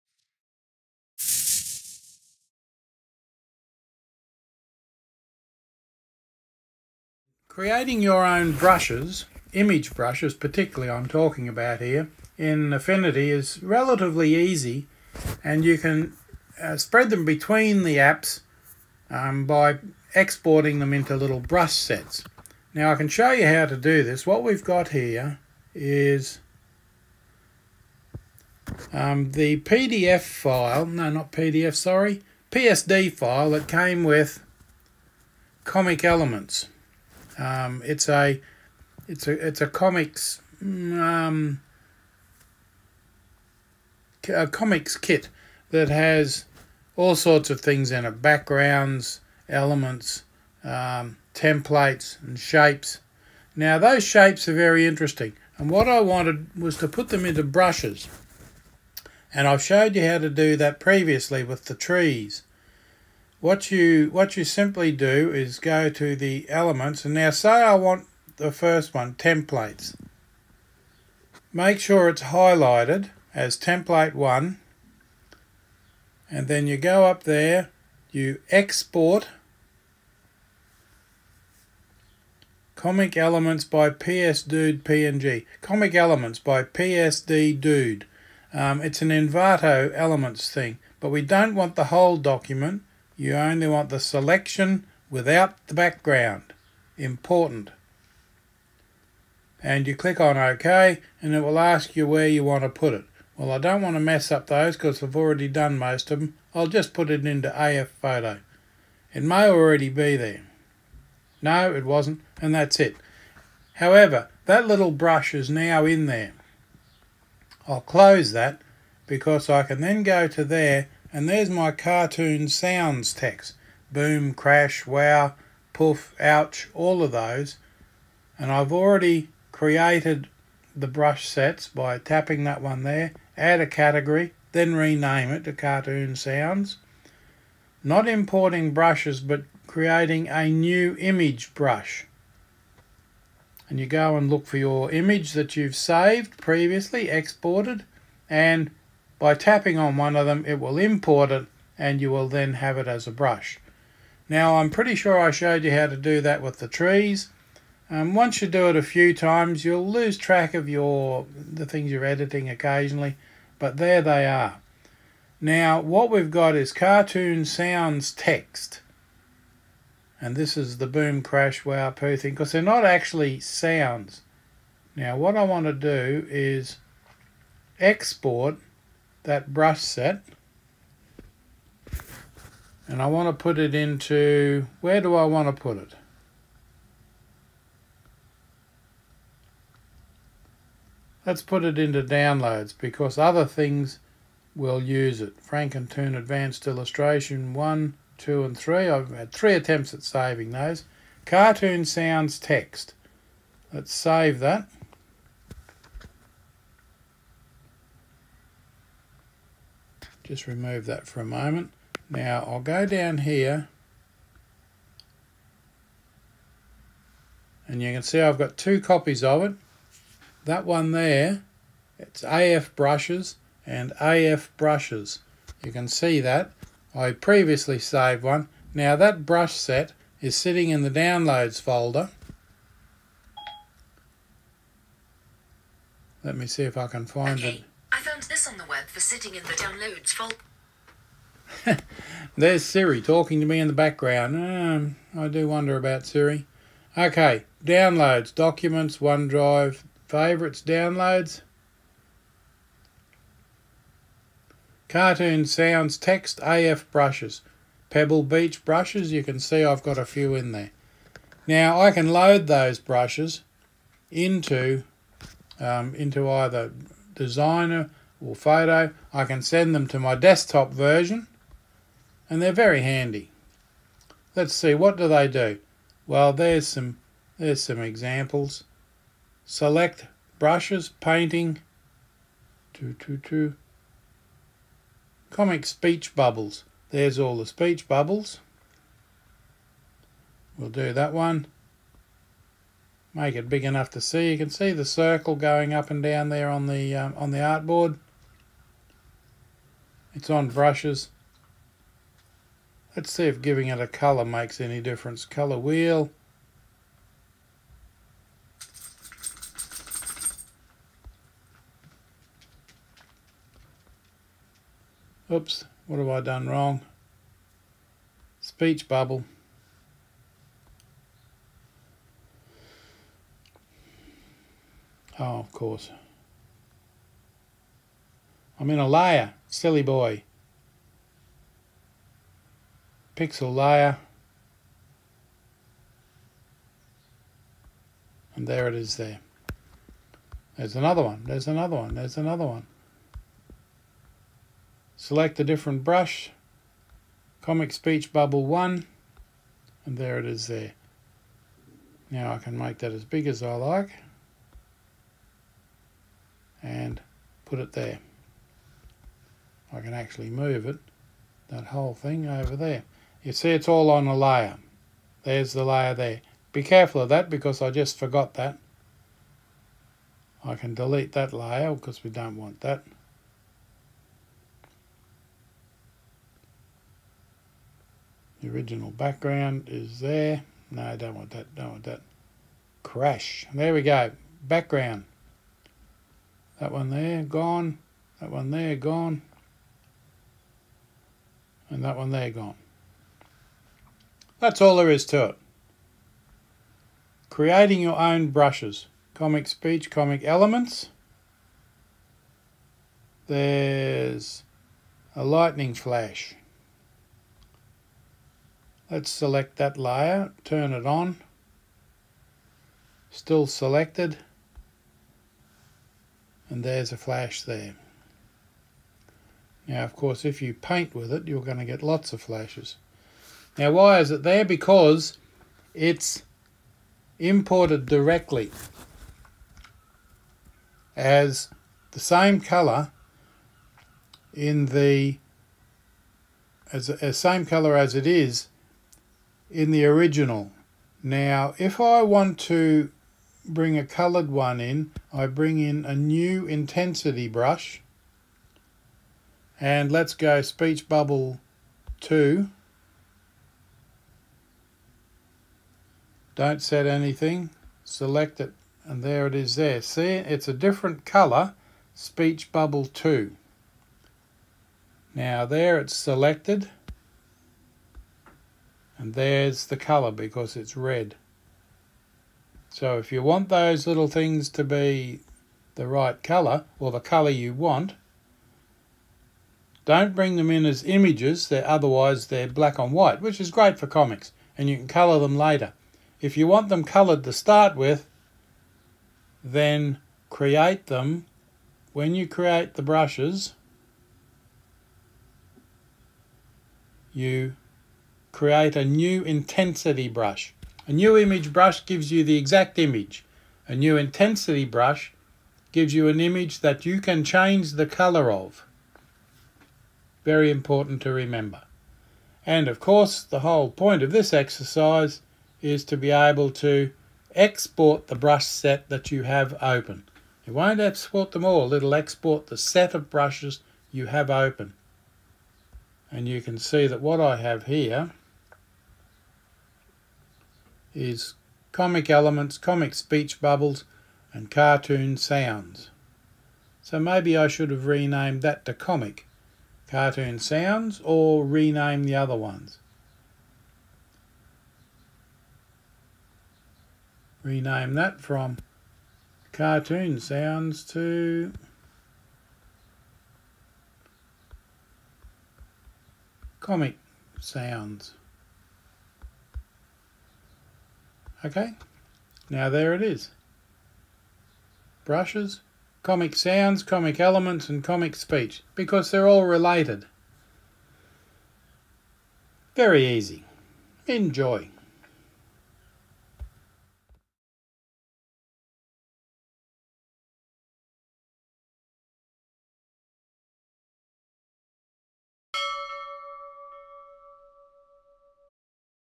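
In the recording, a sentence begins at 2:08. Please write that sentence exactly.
And I've already created the brush sets by tapping that one there, add a category, then rename it to cartoon sounds.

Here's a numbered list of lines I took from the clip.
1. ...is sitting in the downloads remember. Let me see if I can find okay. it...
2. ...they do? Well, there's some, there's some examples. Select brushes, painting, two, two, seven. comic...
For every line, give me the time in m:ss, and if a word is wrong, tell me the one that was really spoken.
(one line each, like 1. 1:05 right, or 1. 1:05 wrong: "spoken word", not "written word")
1. 3:50 wrong: "folder", not "remember"
2. 4:35 wrong: "two", not "seven".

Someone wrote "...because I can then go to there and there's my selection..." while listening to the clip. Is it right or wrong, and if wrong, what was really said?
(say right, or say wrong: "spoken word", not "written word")
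wrong: "cartoon", not "selection".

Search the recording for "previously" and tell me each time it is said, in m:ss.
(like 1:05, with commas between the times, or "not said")
1:00, 2:26, 3:47.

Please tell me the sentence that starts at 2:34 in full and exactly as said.
Now, I'm pretty sure I showed you how to do that with the trees.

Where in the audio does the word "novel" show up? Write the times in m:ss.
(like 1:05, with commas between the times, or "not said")
not said.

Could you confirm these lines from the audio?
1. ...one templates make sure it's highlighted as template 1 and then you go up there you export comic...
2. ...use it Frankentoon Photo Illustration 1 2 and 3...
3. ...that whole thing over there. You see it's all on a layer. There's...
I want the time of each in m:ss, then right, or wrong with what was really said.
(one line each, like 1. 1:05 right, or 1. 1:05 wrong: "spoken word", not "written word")
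1. 1:08 right
2. 3:14 wrong: "Advanced", not "Photo"
3. 6:01 right.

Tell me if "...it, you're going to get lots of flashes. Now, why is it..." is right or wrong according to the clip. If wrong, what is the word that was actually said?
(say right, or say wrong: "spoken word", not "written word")
right.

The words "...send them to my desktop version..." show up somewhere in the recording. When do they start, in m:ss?
4:29.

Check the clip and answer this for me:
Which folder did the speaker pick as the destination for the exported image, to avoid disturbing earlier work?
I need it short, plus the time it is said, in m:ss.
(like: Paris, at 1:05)
AF Photo, at 1:47.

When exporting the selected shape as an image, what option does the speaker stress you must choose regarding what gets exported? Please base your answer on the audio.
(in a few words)
selection without the background.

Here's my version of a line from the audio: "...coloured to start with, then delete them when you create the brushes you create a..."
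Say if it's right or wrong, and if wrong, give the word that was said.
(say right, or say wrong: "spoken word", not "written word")
wrong: "create", not "delete".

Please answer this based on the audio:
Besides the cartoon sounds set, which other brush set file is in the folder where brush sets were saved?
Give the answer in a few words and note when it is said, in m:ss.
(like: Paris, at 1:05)
Pebble Beach brushes, at 4:17.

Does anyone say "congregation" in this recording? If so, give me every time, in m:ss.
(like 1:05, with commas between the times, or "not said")
not said.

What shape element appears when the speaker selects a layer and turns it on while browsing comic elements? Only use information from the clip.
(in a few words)
lightning flash.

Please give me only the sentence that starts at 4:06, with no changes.
Okay, downloads, documents, OneDrive, favorites, downloads.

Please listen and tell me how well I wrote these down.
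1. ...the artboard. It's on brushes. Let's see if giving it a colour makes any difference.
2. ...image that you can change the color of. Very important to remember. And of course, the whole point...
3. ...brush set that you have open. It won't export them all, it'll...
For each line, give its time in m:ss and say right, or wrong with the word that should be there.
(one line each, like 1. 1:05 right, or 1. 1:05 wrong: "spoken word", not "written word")
1. 4:57 right
2. 8:26 right
3. 8:38 right.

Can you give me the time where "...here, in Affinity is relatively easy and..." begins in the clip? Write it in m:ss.
0:11.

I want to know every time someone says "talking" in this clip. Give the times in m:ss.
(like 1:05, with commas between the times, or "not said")
0:11, 4:02.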